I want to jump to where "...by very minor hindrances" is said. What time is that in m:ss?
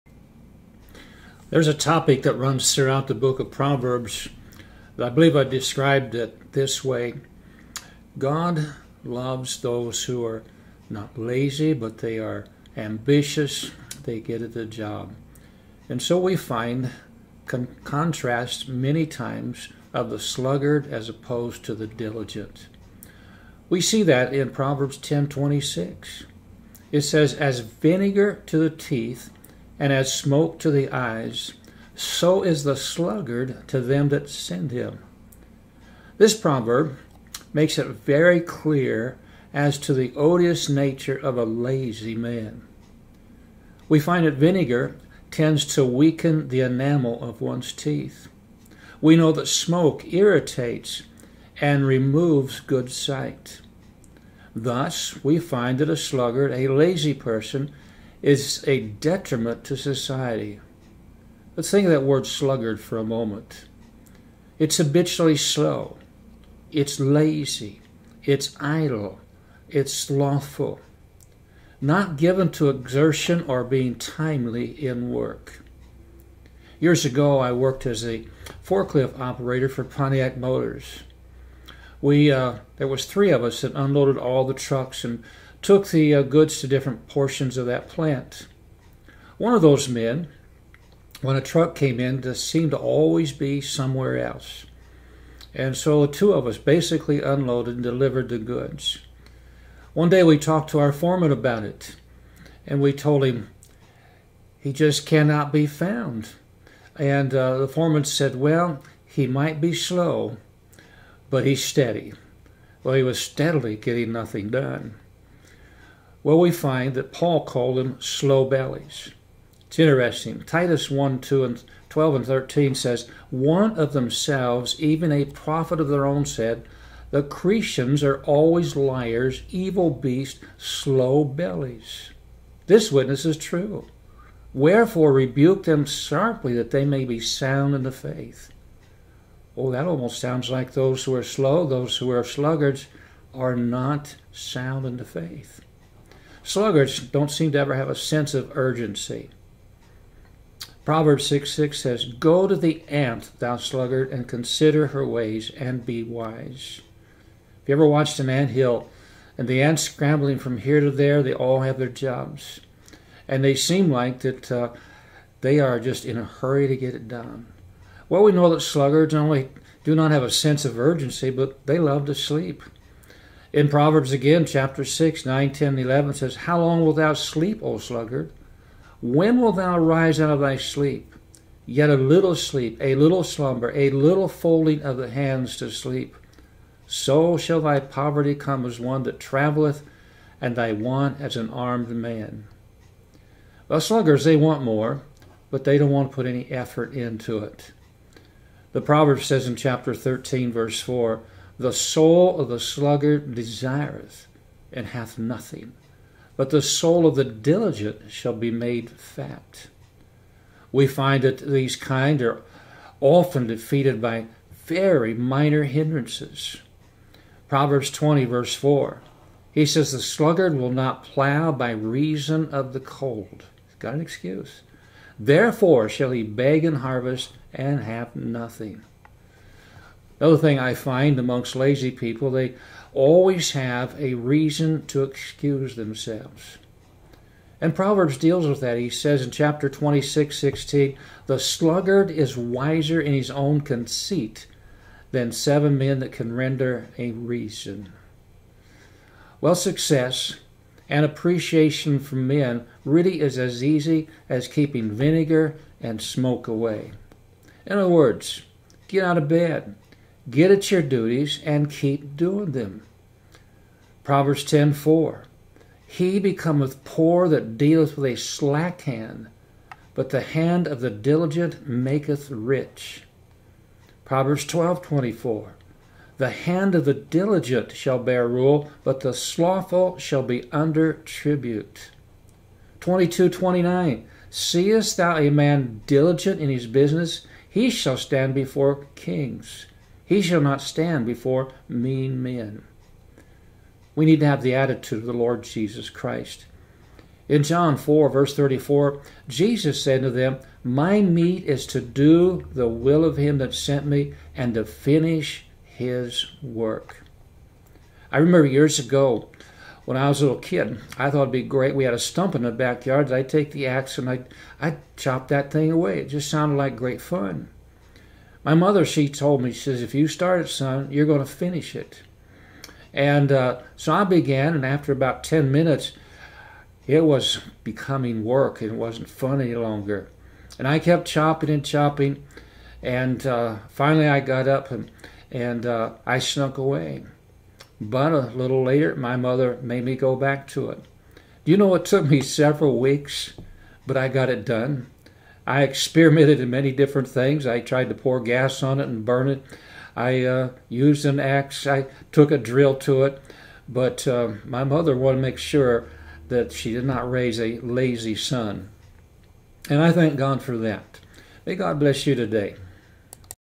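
3:34.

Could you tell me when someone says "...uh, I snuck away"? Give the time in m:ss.
5:35.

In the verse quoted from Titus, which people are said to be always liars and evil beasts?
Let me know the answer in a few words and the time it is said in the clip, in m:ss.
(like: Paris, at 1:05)
The Cretians, at 2:07.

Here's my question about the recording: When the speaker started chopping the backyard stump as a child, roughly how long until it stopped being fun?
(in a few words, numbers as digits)
10 minutes.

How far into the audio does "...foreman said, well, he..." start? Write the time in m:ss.
1:47.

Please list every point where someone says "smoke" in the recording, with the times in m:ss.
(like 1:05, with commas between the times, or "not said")
0:30, 0:49, 4:15.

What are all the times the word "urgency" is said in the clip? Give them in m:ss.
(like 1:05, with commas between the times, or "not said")
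2:28, 2:50.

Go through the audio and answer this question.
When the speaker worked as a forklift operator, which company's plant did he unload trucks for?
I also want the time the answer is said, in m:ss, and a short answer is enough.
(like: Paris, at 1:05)
Pontiac Motors, at 1:19.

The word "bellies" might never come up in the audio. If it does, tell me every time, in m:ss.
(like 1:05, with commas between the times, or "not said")
1:58, 2:11.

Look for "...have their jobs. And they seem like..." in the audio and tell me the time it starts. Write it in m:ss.
2:41.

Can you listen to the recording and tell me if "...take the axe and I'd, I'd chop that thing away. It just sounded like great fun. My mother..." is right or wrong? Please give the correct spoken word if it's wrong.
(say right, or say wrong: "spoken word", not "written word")
right.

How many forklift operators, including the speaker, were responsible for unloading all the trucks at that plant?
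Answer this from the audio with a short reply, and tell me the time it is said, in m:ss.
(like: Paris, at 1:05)
3, at 1:23.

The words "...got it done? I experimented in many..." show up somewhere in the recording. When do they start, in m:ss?
5:44.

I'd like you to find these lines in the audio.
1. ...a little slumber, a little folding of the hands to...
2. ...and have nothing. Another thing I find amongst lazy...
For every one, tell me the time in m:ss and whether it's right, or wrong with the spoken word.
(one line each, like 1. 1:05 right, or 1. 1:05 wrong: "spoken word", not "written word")
1. 3:02 right
2. 3:47 right.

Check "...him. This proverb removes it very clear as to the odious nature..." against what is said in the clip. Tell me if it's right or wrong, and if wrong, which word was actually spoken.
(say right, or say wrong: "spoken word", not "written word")
wrong: "makes", not "removes".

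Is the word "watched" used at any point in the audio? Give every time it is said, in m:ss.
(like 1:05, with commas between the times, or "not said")
2:37.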